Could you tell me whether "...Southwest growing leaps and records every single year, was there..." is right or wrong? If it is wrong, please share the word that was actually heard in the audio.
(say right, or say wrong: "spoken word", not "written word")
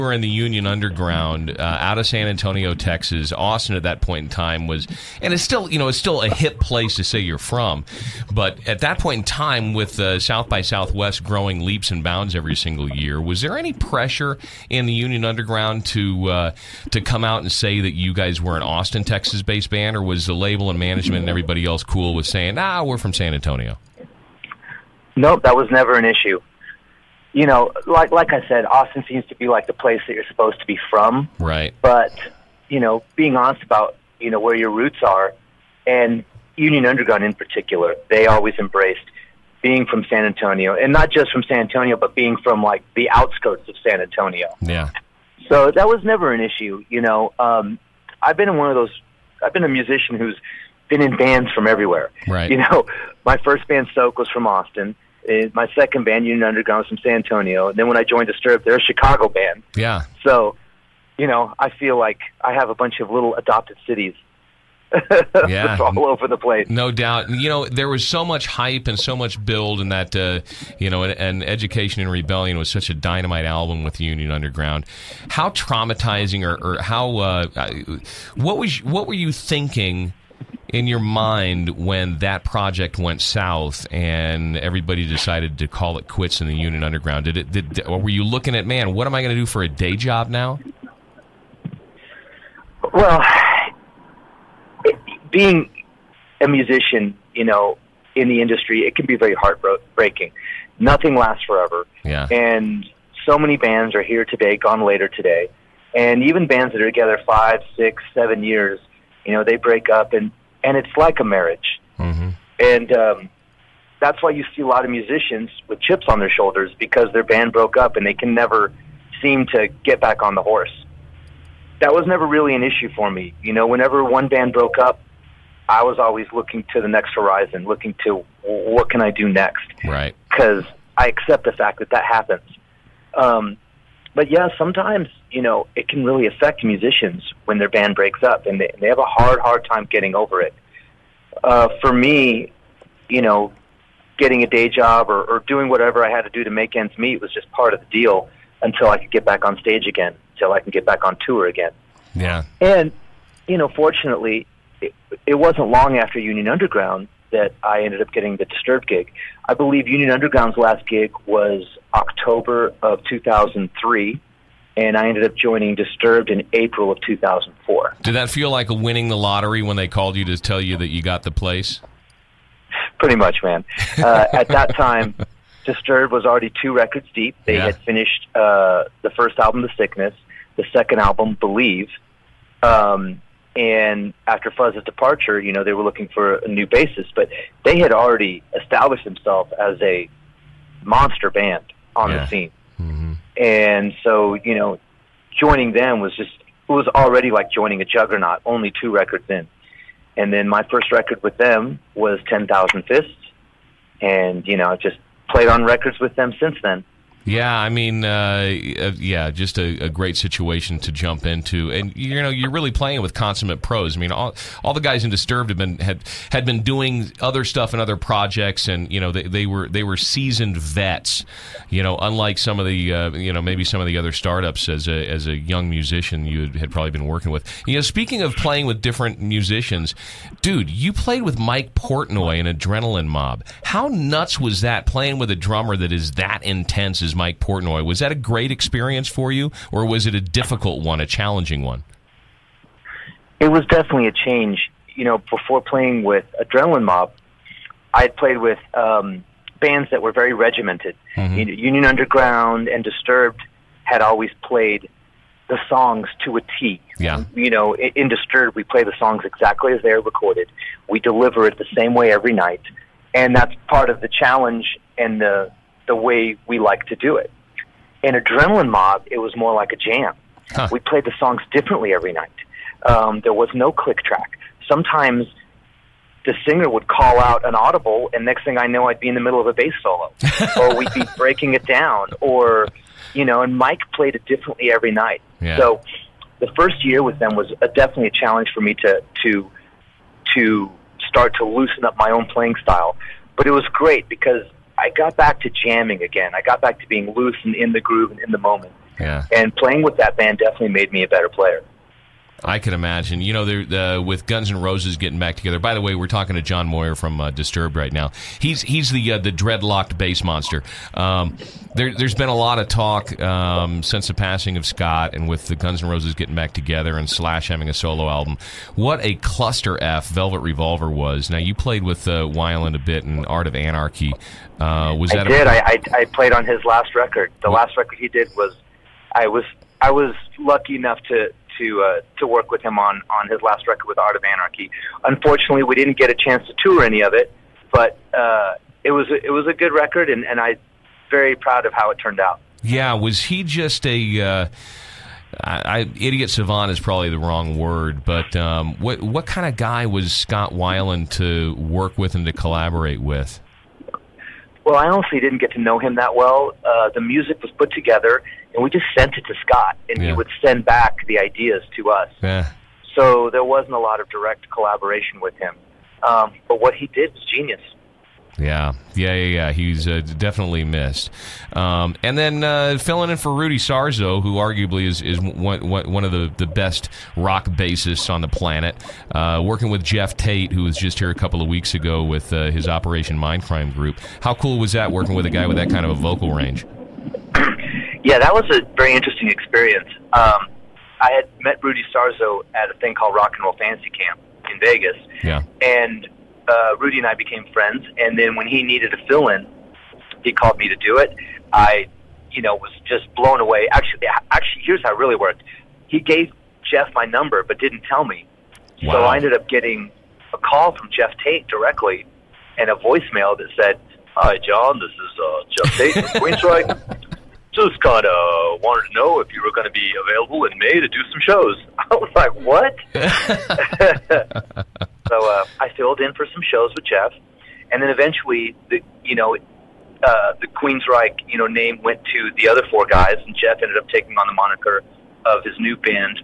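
wrong: "bounds", not "records".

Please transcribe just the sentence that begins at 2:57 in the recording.
had finished uh, the first album, The Sickness, the second album, Believe.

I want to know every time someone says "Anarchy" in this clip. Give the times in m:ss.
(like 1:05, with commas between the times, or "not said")
5:23, 5:34.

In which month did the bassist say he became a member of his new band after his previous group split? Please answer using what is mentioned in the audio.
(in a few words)
April.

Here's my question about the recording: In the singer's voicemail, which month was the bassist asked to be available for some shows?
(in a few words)
May.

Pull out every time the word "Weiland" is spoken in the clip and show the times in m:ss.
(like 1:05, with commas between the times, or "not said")
5:22, 5:50.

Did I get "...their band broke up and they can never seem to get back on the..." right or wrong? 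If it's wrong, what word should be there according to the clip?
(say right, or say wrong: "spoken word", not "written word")
right.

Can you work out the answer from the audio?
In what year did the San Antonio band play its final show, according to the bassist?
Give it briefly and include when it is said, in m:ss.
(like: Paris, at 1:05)
2003, at 2:43.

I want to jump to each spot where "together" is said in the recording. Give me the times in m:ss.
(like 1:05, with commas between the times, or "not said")
1:46, 5:05, 5:16, 5:57.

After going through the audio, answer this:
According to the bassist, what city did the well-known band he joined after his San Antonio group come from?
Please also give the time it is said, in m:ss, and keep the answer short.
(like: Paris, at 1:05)
Chicago, at 0:58.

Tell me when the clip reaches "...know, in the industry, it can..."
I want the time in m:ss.
1:37.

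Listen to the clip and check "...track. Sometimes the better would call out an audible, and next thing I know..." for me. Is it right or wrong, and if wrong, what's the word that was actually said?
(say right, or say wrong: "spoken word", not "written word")
wrong: "singer", not "better".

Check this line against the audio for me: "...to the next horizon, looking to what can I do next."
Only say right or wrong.
right.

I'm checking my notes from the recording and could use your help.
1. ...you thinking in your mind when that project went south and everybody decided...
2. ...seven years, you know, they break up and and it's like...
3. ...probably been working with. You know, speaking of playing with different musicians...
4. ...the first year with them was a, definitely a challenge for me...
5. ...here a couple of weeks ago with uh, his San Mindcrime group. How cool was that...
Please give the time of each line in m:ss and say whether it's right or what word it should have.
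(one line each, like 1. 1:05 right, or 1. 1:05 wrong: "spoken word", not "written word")
1. 1:19 right
2. 1:48 right
3. 3:46 right
4. 4:46 right
5. 6:20 wrong: "Operation", not "San".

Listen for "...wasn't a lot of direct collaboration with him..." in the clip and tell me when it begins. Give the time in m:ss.
6:03.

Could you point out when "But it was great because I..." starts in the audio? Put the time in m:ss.
4:53.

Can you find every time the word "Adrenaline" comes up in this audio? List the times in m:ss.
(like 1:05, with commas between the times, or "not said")
3:52, 4:06, 4:28.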